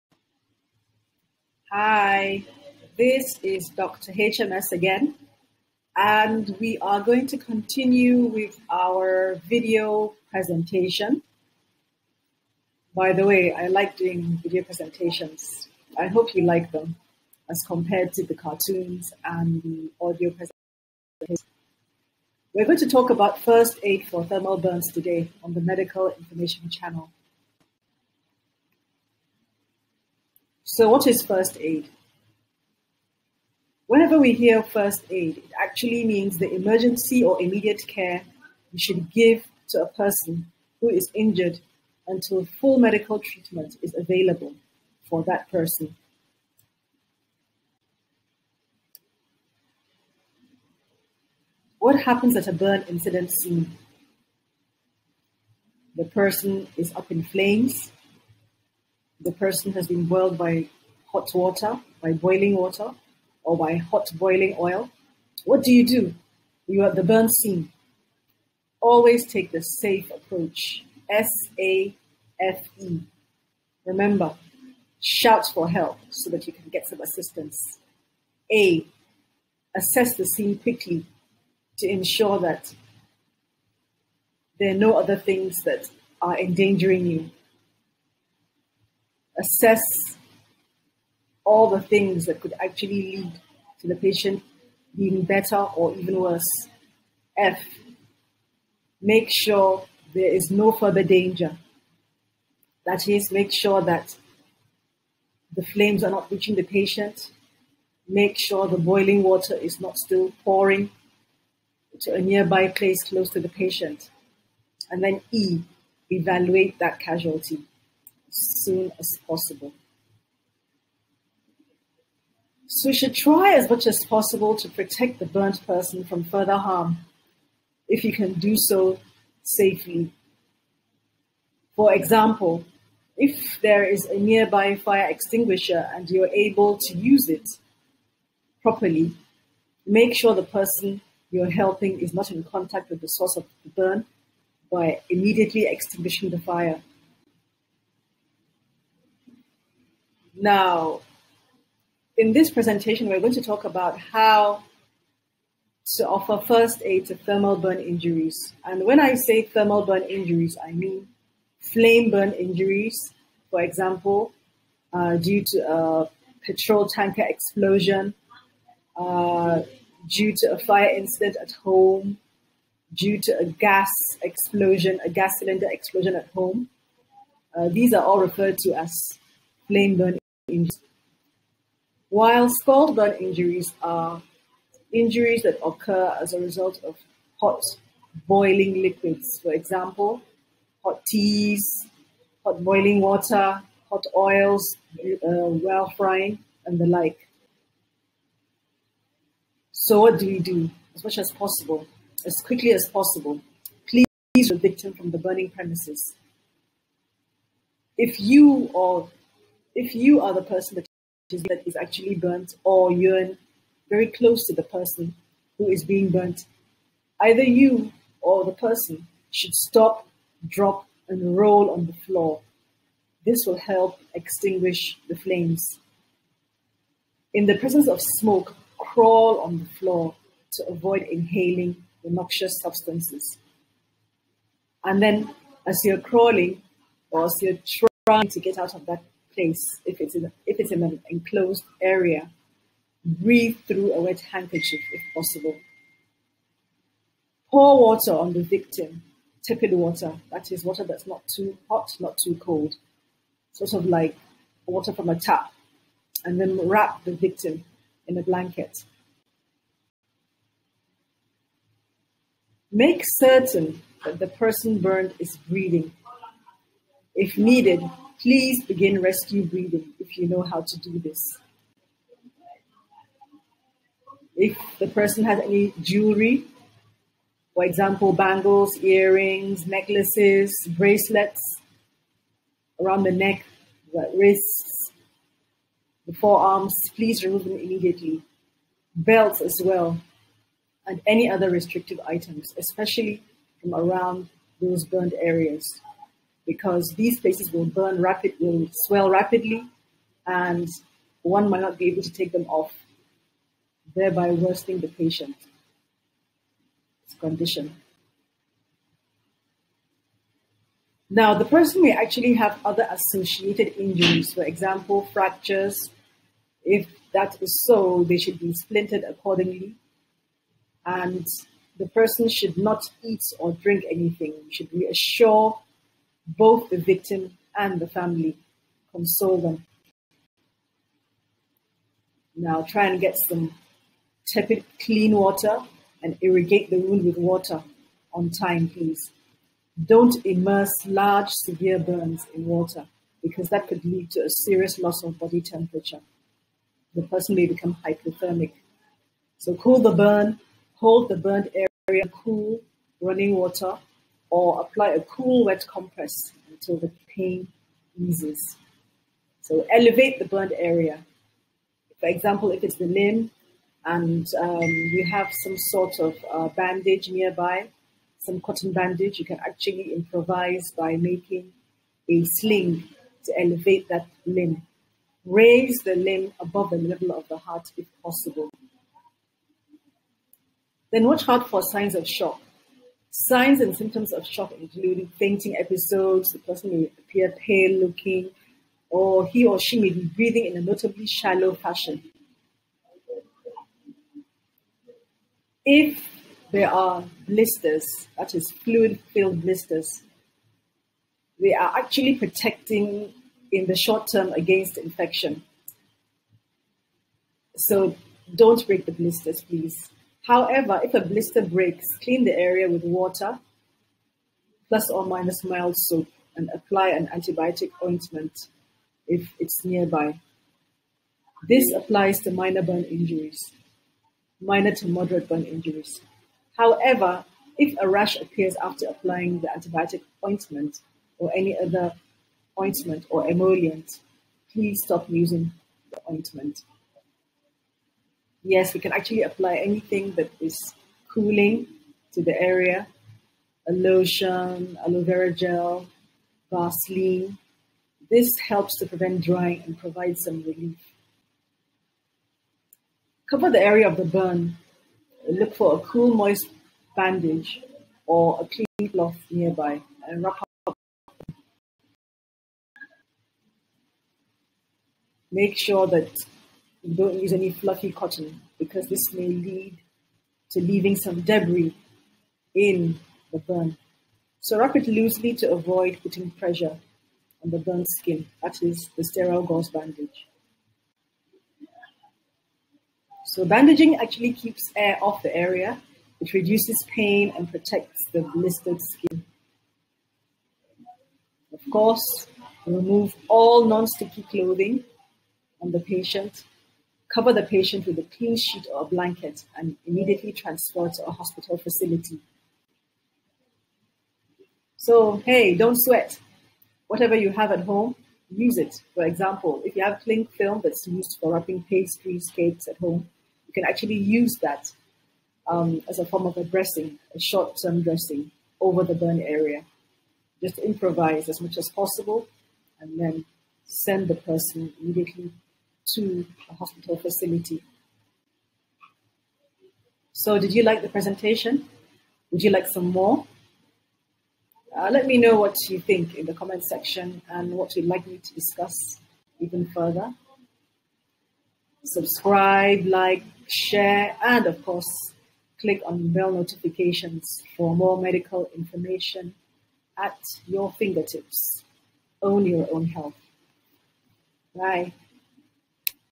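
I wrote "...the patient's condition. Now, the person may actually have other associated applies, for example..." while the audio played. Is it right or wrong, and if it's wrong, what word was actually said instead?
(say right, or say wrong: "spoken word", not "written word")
wrong: "injuries", not "applies".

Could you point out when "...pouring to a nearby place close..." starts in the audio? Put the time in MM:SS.
01:50.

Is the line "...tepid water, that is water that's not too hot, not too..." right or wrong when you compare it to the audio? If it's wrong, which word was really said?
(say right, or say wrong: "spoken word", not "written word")
right.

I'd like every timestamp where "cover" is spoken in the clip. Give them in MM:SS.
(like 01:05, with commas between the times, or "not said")
07:33, 08:17.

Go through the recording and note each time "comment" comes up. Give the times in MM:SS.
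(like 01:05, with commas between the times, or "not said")
08:56.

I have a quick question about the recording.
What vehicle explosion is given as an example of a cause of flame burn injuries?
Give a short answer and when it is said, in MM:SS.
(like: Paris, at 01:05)
petrol tanker, at 02:46.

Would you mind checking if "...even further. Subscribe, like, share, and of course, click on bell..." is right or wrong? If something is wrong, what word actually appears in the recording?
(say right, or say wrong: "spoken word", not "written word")
right.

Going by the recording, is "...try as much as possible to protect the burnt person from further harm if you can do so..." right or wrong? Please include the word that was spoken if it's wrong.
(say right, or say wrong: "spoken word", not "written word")
right.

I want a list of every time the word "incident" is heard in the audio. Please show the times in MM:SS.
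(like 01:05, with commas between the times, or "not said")
00:52, 02:50.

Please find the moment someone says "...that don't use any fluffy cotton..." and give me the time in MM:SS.
07:45.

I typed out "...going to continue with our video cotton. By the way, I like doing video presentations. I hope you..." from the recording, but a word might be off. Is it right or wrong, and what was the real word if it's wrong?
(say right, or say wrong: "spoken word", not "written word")
wrong: "presentation", not "cotton".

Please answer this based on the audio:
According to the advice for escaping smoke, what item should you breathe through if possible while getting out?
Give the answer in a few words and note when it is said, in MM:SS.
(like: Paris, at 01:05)
wet handkerchief, at 04:04.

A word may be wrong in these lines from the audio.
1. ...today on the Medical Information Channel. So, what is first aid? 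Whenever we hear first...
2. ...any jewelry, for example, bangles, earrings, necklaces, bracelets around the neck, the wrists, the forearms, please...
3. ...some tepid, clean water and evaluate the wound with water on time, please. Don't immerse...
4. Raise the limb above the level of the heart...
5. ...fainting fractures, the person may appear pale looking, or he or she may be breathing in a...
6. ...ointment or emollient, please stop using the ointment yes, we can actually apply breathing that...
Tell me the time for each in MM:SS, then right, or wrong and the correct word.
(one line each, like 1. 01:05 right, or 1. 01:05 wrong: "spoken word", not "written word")
1. 00:24 right
2. 04:35 right
3. 05:33 wrong: "irrigate", not "evaluate"
4. 06:15 right
5. 06:25 wrong: "episodes", not "fractures"
6. 07:12 wrong: "anything", not "breathing".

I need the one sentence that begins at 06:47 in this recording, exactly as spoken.
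So don't break the blisters, please.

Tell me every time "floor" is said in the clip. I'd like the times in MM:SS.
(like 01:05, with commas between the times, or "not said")
03:41, 03:49.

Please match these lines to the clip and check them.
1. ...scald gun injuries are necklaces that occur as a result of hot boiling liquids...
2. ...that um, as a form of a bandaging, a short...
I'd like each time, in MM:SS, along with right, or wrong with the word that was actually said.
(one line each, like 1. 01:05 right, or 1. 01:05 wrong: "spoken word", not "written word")
1. 03:02 wrong: "injuries", not "necklaces"
2. 08:34 wrong: "dressing", not "bandaging".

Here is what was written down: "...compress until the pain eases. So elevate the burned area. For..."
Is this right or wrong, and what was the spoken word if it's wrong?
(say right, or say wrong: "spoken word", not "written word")
right.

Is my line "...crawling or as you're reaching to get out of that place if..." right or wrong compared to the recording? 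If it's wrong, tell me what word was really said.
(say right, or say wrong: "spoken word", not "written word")
wrong: "trying", not "reaching".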